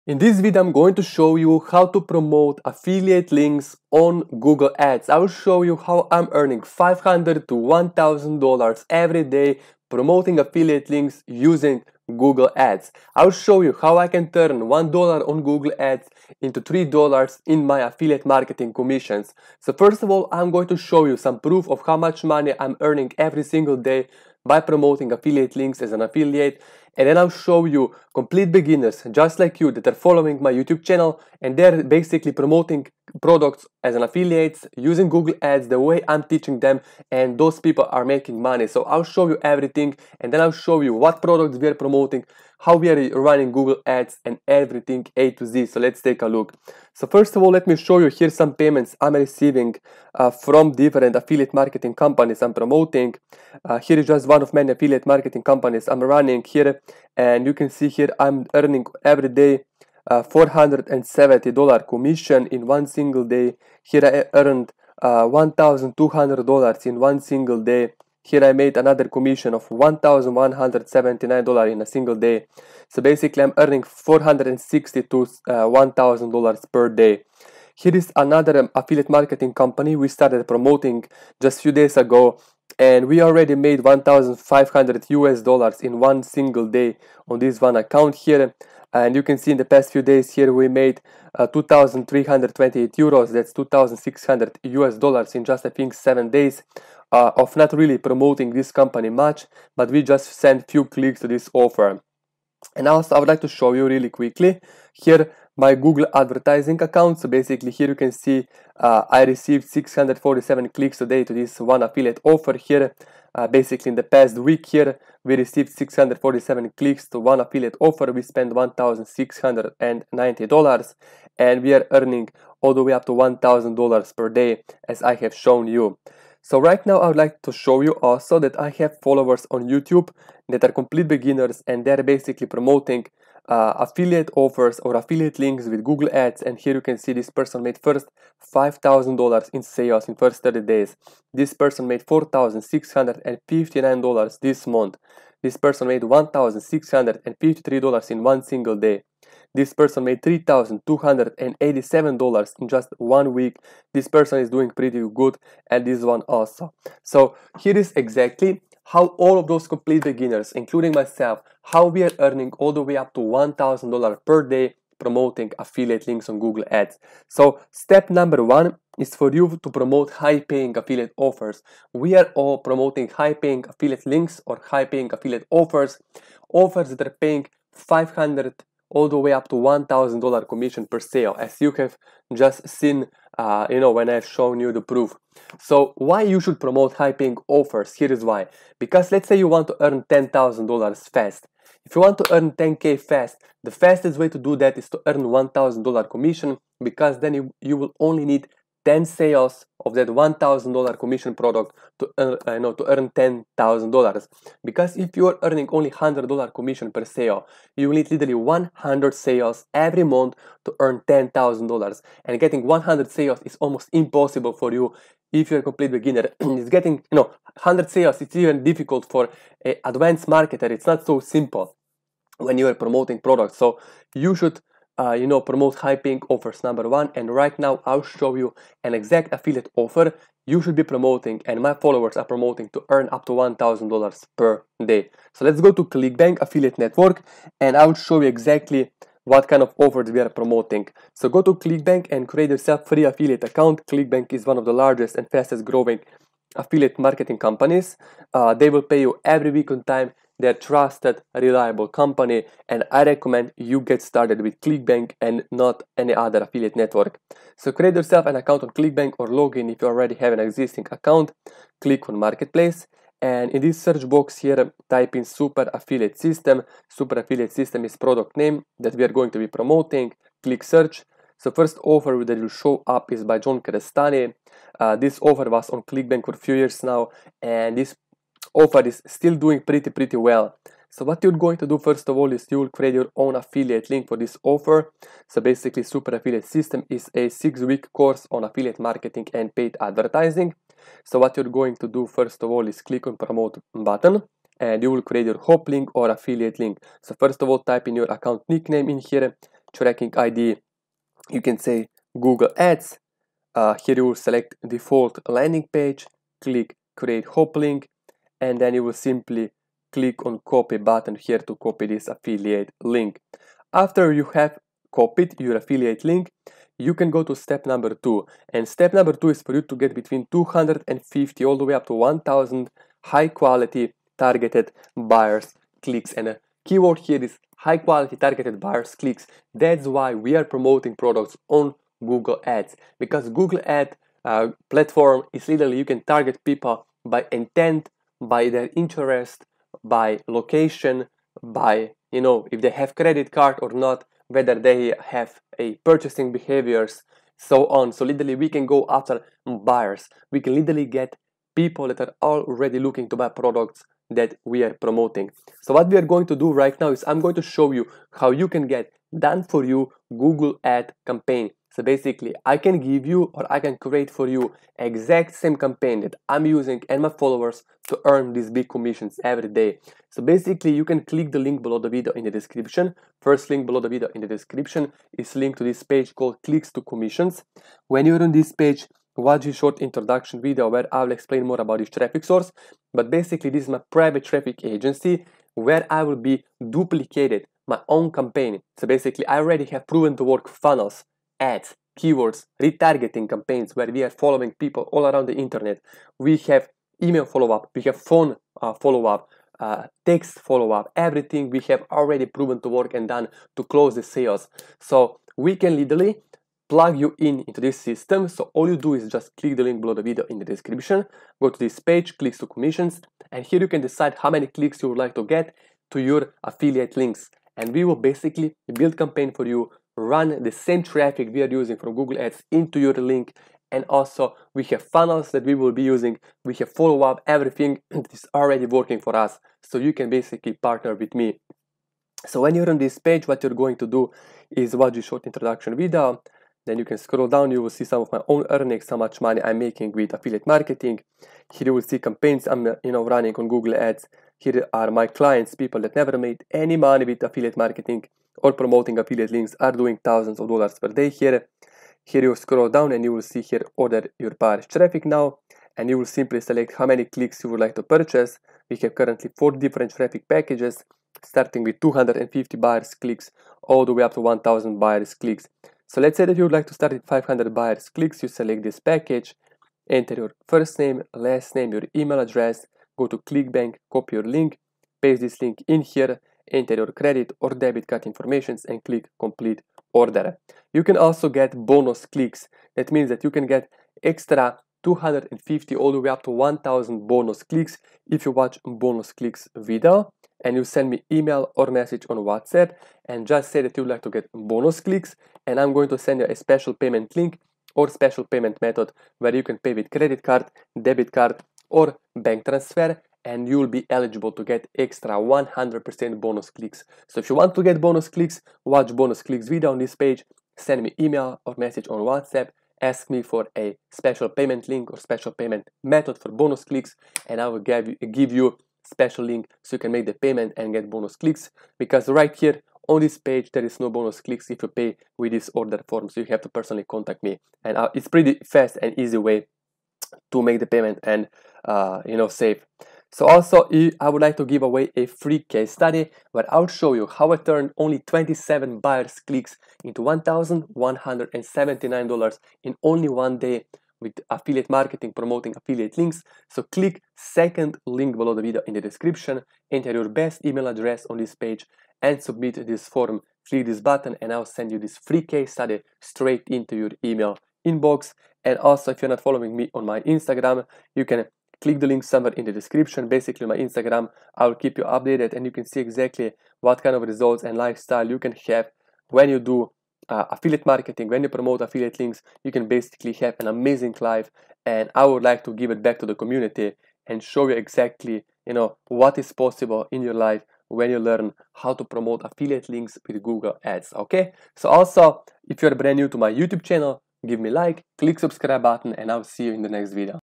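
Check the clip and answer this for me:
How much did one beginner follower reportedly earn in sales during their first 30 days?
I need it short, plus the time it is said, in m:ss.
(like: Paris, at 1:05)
$5,000, at 2:18.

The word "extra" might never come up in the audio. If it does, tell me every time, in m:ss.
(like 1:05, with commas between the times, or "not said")
8:04, 8:24.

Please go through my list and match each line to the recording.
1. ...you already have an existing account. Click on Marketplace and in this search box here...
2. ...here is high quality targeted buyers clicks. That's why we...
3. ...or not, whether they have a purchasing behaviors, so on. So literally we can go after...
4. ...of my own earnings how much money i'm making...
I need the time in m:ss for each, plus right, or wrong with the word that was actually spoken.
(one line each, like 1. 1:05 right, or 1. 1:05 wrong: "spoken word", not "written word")
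1. 4:19 right
2. 5:26 right
3. 5:43 right
4. 7:18 right.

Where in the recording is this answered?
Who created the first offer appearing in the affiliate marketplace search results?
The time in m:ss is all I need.
4:33.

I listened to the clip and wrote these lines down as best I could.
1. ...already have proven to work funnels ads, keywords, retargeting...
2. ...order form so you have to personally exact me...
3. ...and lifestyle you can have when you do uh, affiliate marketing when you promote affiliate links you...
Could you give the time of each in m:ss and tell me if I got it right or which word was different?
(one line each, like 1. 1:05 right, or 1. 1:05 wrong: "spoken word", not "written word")
1. 6:29 right
2. 8:45 wrong: "contact", not "exact"
3. 9:27 right.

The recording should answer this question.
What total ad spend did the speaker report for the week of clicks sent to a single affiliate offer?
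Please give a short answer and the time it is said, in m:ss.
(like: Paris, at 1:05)
$1,690, at 1:58.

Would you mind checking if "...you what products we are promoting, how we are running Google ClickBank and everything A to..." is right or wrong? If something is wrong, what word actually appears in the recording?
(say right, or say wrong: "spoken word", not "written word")
wrong: "Ads", not "ClickBank".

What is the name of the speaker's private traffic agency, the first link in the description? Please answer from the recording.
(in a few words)
Clicks to Commissions.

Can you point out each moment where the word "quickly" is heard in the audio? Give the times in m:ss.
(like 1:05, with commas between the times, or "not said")
1:44.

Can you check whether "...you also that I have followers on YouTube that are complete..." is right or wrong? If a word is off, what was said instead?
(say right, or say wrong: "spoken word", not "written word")
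right.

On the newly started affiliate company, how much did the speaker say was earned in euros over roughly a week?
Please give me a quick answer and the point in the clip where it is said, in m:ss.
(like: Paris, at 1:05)
2328 euros, at 1:31.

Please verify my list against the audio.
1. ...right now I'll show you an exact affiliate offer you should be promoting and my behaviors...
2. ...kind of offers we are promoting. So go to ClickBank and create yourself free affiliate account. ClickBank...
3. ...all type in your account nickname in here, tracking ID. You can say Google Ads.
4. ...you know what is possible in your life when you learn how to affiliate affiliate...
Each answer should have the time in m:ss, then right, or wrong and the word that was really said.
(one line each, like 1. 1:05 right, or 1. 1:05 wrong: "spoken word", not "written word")
1. 3:47 wrong: "followers", not "behaviors"
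2. 3:59 right
3. 4:57 right
4. 9:38 wrong: "promote", not "affiliate".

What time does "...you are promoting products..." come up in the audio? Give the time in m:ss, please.
3:42.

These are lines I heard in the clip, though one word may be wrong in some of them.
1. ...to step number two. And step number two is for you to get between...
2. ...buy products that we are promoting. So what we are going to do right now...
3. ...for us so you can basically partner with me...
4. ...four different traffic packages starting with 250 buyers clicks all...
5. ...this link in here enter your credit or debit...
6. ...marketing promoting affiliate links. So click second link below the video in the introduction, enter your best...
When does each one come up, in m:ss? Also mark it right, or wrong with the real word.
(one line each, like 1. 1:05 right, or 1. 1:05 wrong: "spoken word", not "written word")
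1. 5:17 right
2. 5:53 right
3. 7:08 right
4. 7:39 right
5. 7:55 right
6. 9:04 wrong: "description", not "introduction".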